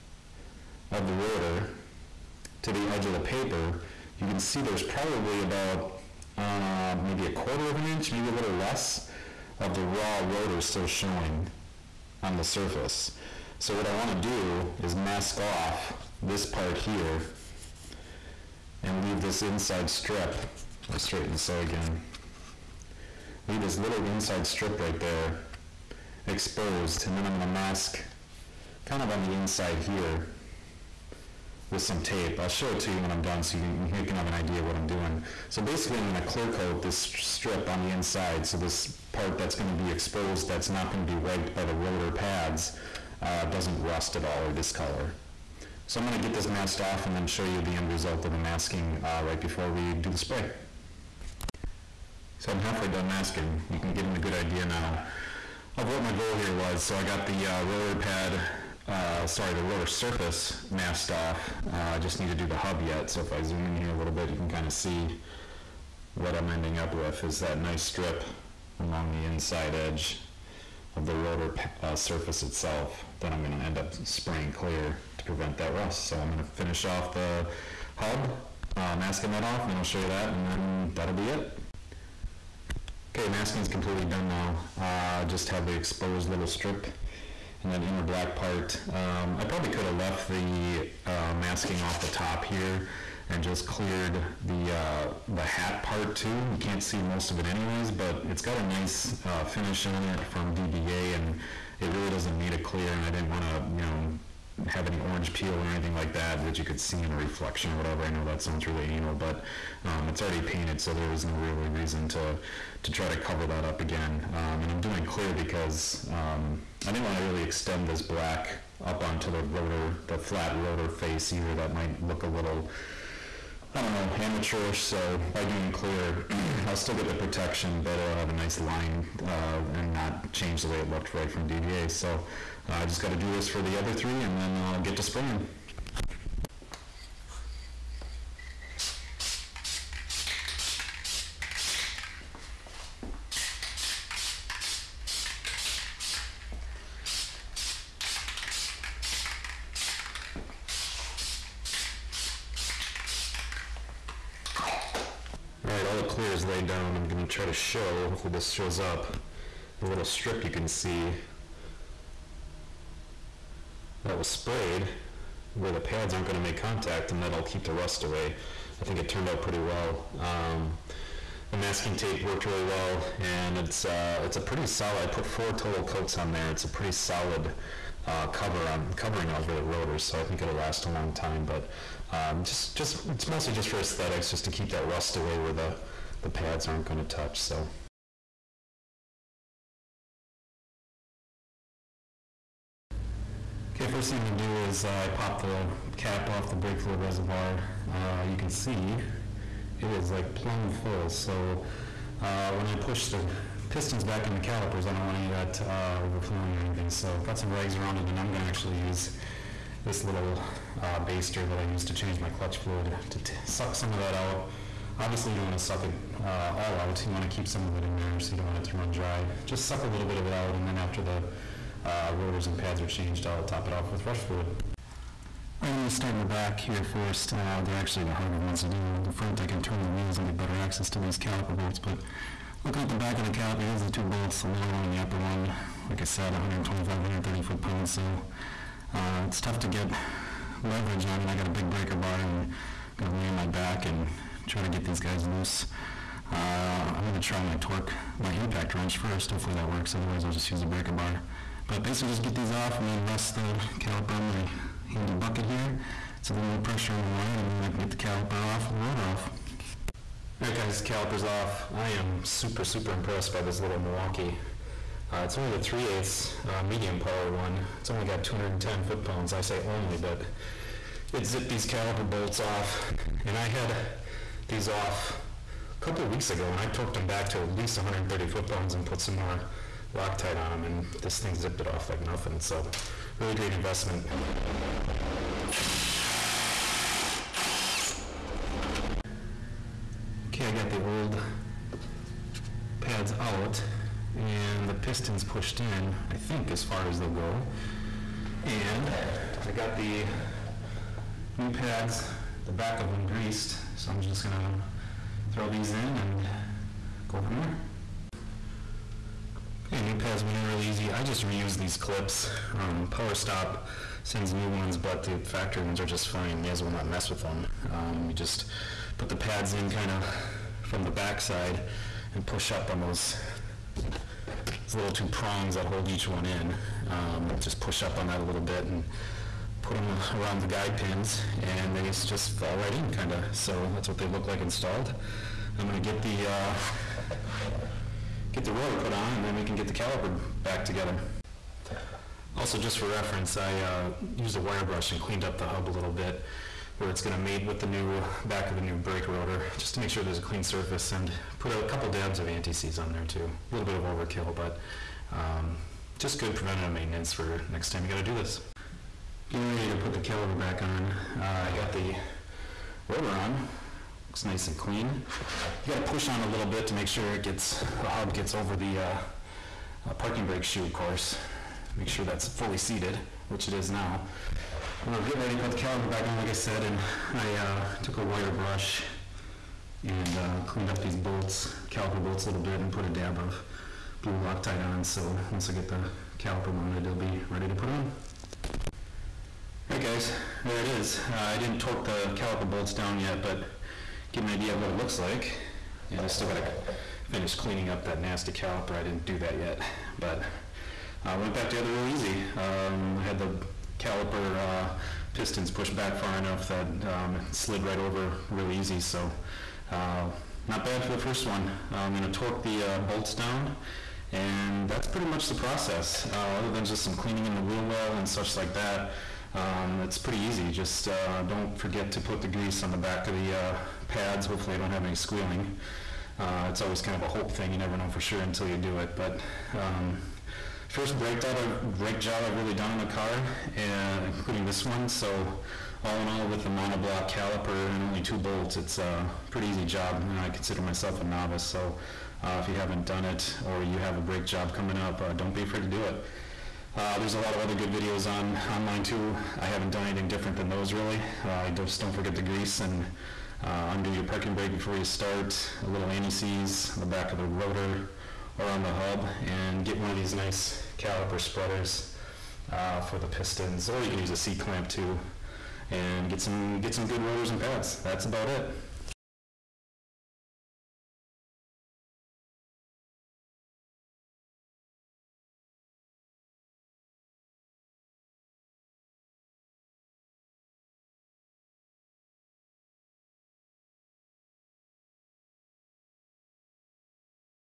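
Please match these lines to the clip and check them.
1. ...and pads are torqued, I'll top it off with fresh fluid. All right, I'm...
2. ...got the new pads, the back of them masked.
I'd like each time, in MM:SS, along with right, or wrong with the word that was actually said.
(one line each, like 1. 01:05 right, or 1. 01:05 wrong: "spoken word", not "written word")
1. 03:42 wrong: "changed", not "torqued"
2. 04:59 wrong: "greased", not "masked".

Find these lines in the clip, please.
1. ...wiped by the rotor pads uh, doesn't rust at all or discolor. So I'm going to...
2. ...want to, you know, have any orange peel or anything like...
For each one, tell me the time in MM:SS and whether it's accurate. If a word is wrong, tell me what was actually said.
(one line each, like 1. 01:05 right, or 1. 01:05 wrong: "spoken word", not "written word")
1. 00:41 right
2. 01:43 right.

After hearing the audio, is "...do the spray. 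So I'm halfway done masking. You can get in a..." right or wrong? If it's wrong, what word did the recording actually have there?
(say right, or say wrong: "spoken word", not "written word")
right.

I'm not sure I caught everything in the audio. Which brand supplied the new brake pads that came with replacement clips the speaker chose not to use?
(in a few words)
Power Stop.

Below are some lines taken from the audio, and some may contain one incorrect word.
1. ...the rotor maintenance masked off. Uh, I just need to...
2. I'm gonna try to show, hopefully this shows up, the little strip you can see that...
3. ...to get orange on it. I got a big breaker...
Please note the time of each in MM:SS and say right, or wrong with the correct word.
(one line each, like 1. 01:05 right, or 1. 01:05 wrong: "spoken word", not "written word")
1. 00:59 wrong: "surface", not "maintenance"
2. 02:36 right
3. 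03:59 wrong: "leverage", not "orange".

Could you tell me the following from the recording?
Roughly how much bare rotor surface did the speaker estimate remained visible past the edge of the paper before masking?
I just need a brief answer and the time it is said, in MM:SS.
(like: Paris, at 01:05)
a quarter of an inch, at 00:07.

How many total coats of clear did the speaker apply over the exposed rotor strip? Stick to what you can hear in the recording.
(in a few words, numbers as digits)
4.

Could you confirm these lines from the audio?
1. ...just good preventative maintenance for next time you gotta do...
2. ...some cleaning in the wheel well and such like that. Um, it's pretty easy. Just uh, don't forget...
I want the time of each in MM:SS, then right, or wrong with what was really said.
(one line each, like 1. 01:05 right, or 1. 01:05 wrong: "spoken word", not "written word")
1. 05:55 right
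2. 06:56 right.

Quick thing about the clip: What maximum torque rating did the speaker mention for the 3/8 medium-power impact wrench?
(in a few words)
210 foot-pounds.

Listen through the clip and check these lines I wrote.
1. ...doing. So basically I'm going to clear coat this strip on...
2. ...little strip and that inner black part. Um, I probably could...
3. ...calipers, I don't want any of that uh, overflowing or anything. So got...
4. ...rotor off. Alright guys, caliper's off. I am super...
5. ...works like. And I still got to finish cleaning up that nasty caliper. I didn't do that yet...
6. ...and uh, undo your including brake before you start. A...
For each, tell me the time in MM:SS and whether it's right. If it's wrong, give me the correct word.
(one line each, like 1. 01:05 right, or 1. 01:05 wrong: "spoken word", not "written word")
1. 00:34 right
2. 01:26 right
3. 03:24 right
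4. 04:18 right
5. 06:34 wrong: "looks", not "works"
6. 07:32 wrong: "parking", not "including".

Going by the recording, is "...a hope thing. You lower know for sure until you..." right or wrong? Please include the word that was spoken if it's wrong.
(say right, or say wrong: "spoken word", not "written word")
wrong: "never", not "lower".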